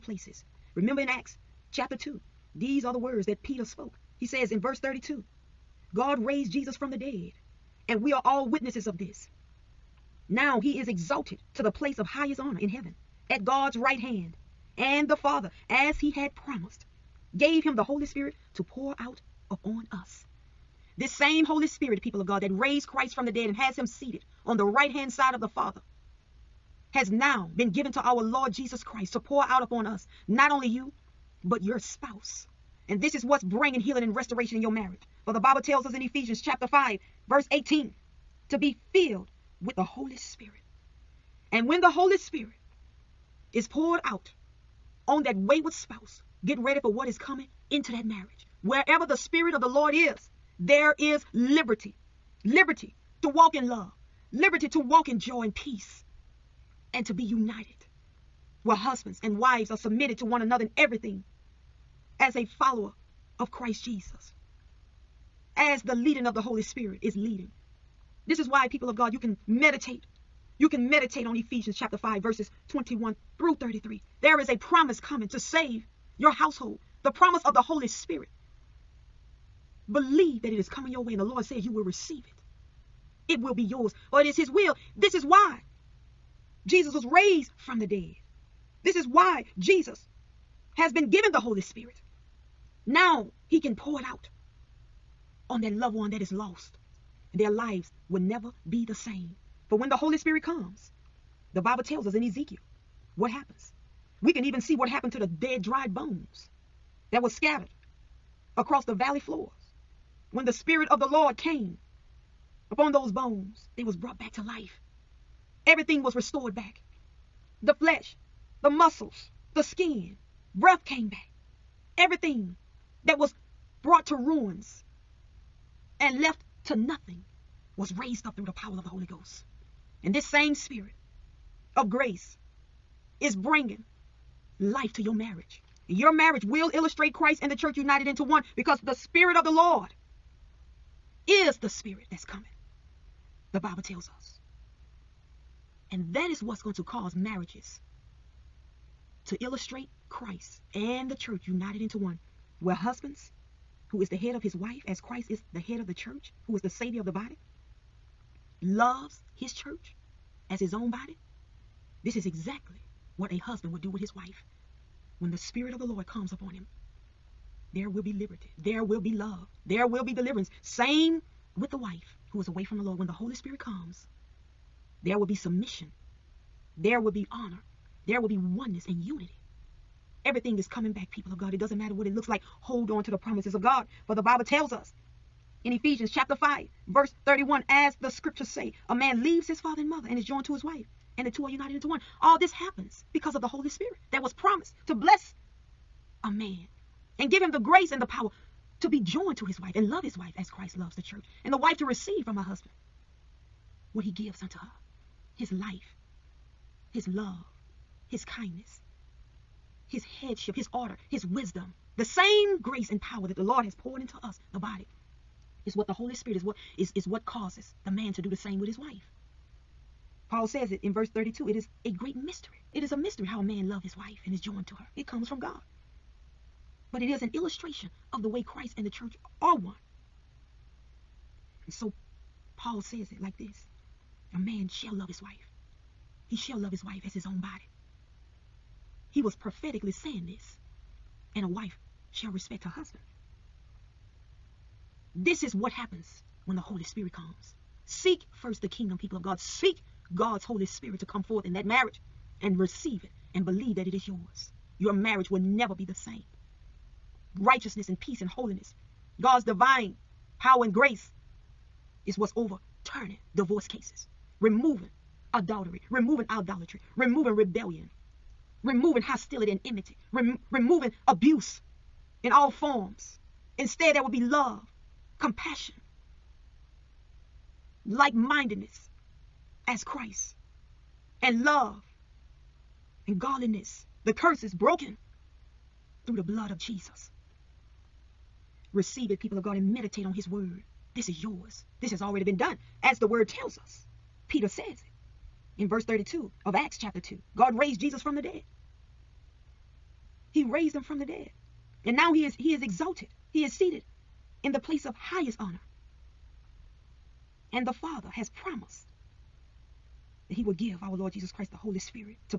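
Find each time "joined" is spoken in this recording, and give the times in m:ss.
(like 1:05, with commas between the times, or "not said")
3:10, 3:19, 3:44.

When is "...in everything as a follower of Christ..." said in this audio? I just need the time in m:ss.
1:00.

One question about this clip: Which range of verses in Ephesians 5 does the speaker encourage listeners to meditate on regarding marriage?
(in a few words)
21 through 33.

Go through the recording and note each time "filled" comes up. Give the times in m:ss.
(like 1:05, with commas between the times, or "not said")
0:38.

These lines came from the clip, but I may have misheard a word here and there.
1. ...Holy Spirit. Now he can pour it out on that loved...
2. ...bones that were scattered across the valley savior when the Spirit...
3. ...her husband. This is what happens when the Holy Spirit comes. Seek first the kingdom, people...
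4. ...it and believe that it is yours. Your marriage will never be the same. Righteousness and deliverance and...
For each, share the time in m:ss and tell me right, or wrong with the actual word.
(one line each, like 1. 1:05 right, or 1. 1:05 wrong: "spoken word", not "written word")
1. 1:31 right
2. 1:45 wrong: "floor", not "savior"
3. 4:02 right
4. 4:13 wrong: "peace", not "deliverance".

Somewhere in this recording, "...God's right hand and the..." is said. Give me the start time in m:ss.
0:13.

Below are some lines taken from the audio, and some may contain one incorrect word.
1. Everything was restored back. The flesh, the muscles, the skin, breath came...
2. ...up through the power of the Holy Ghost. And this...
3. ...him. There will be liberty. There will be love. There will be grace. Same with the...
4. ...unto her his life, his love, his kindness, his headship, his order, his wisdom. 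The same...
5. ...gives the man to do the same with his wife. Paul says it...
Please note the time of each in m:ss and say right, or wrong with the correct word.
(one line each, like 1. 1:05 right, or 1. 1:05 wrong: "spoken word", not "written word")
1. 1:55 right
2. 2:08 right
3. 2:46 wrong: "deliverance", not "grace"
4. 3:24 right
5. 3:37 wrong: "causes", not "gives".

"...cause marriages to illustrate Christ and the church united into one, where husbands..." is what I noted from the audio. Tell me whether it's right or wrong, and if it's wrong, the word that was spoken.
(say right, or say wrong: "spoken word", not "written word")
right.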